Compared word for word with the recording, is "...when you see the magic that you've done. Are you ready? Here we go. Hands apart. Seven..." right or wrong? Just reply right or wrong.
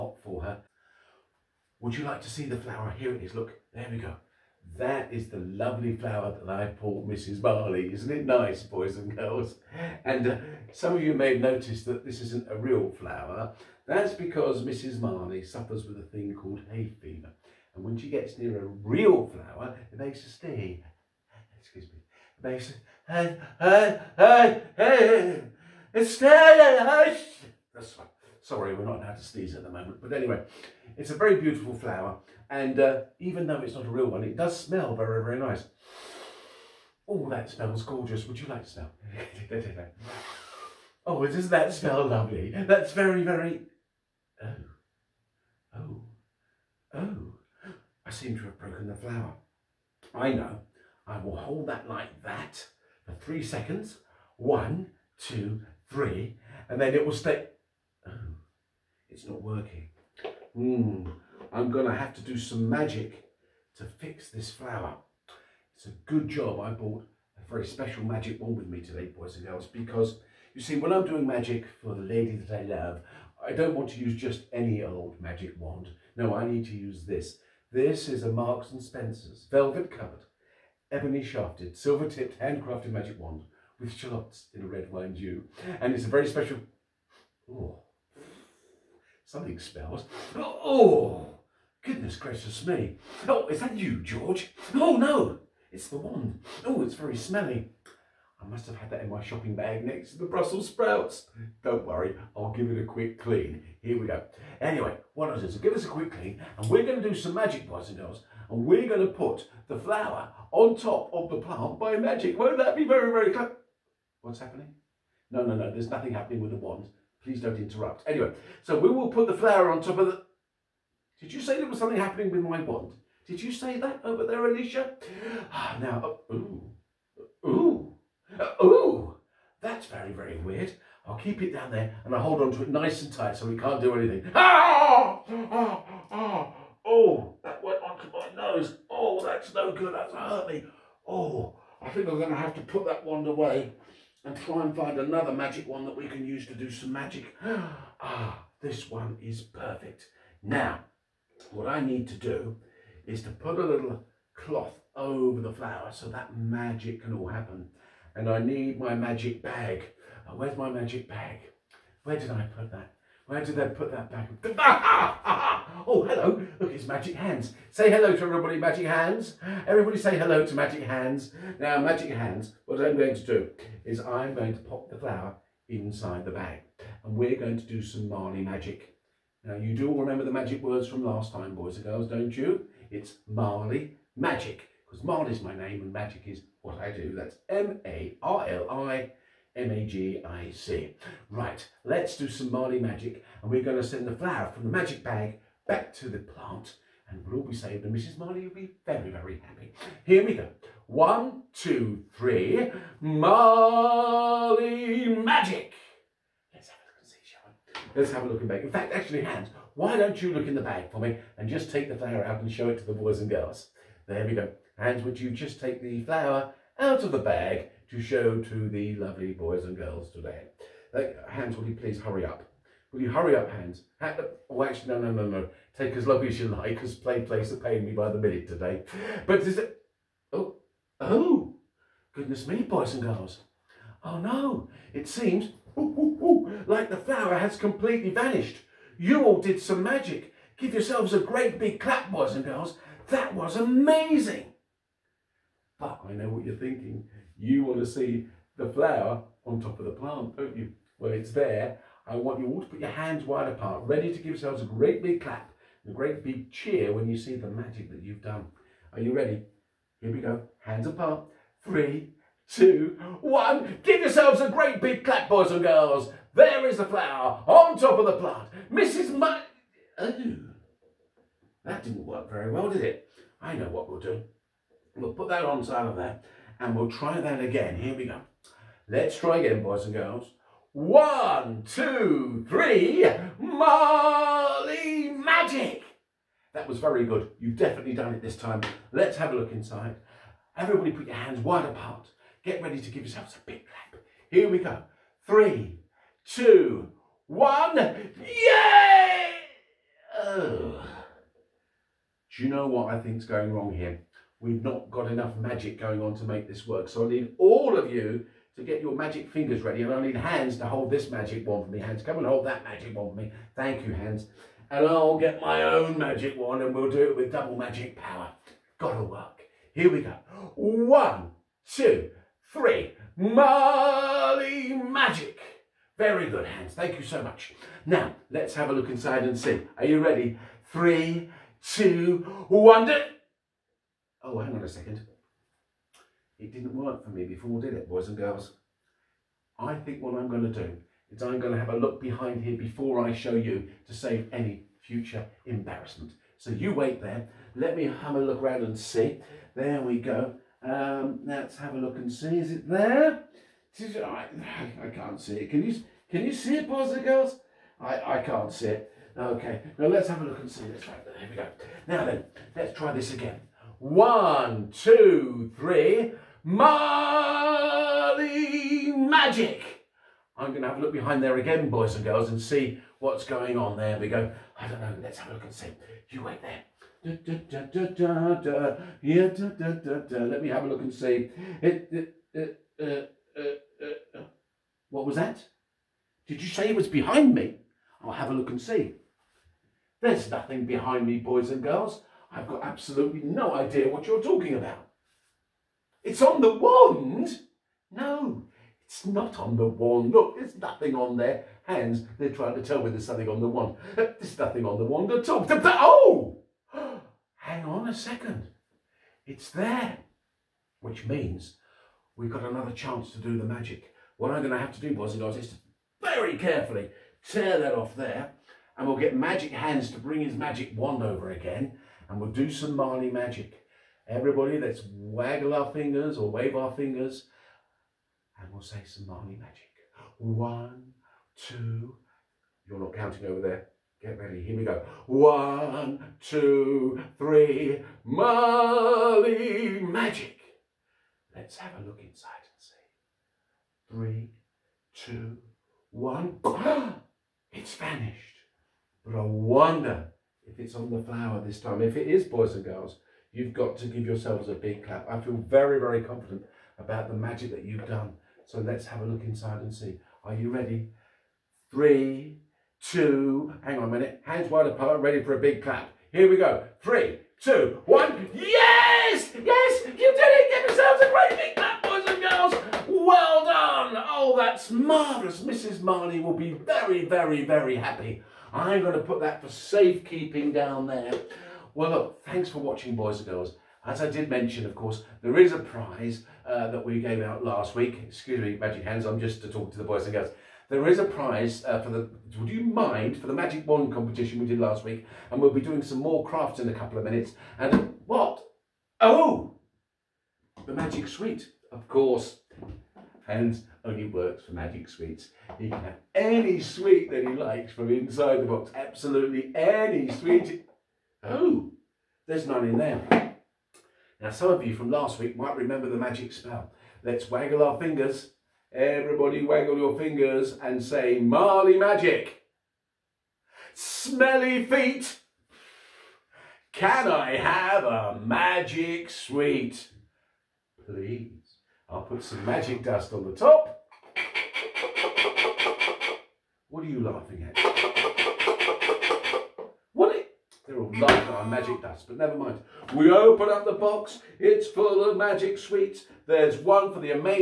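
wrong.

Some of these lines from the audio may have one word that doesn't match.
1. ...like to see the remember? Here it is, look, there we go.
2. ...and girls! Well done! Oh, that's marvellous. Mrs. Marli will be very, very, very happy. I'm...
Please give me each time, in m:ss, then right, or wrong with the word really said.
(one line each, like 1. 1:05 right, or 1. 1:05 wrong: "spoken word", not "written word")
1. 0:02 wrong: "flower", not "remember"
2. 7:52 right.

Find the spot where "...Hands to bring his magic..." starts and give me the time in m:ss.
6:59.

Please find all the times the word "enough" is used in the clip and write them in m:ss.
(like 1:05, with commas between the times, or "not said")
5:05.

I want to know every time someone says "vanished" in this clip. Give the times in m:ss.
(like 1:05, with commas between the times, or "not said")
3:58, 7:27.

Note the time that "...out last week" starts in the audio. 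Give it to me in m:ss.
8:07.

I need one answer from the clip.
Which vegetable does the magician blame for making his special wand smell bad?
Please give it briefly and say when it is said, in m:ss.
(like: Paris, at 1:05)
Brussels sprouts, at 1:40.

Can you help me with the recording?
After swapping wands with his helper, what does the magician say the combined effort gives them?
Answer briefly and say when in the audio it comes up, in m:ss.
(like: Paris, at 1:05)
Double magic power, at 5:17.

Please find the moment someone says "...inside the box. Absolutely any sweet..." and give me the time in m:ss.
8:27.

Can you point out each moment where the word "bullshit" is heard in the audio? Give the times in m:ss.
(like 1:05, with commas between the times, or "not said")
not said.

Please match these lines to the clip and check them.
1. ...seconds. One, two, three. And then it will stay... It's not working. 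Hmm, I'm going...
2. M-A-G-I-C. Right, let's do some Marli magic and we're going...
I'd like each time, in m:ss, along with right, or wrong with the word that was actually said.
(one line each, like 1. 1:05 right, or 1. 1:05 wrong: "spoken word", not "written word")
1. 0:53 right
2. 3:09 right.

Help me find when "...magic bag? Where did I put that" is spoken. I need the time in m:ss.
2:40.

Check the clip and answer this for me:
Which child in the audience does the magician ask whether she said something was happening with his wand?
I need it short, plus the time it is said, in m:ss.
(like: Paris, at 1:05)
Alicia, at 2:04.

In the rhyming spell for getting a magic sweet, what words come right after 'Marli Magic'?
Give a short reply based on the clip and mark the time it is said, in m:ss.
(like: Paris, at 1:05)
Smelly feet, at 8:43.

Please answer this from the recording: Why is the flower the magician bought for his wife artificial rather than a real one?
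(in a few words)
Hay fever.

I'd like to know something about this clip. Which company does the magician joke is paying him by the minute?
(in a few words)
PlayPlace.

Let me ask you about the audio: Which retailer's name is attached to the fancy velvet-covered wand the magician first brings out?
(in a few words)
Marks and Spencer's.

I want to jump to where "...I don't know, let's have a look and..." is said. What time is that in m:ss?
6:14.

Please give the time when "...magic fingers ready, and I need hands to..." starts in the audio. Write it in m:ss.
5:08.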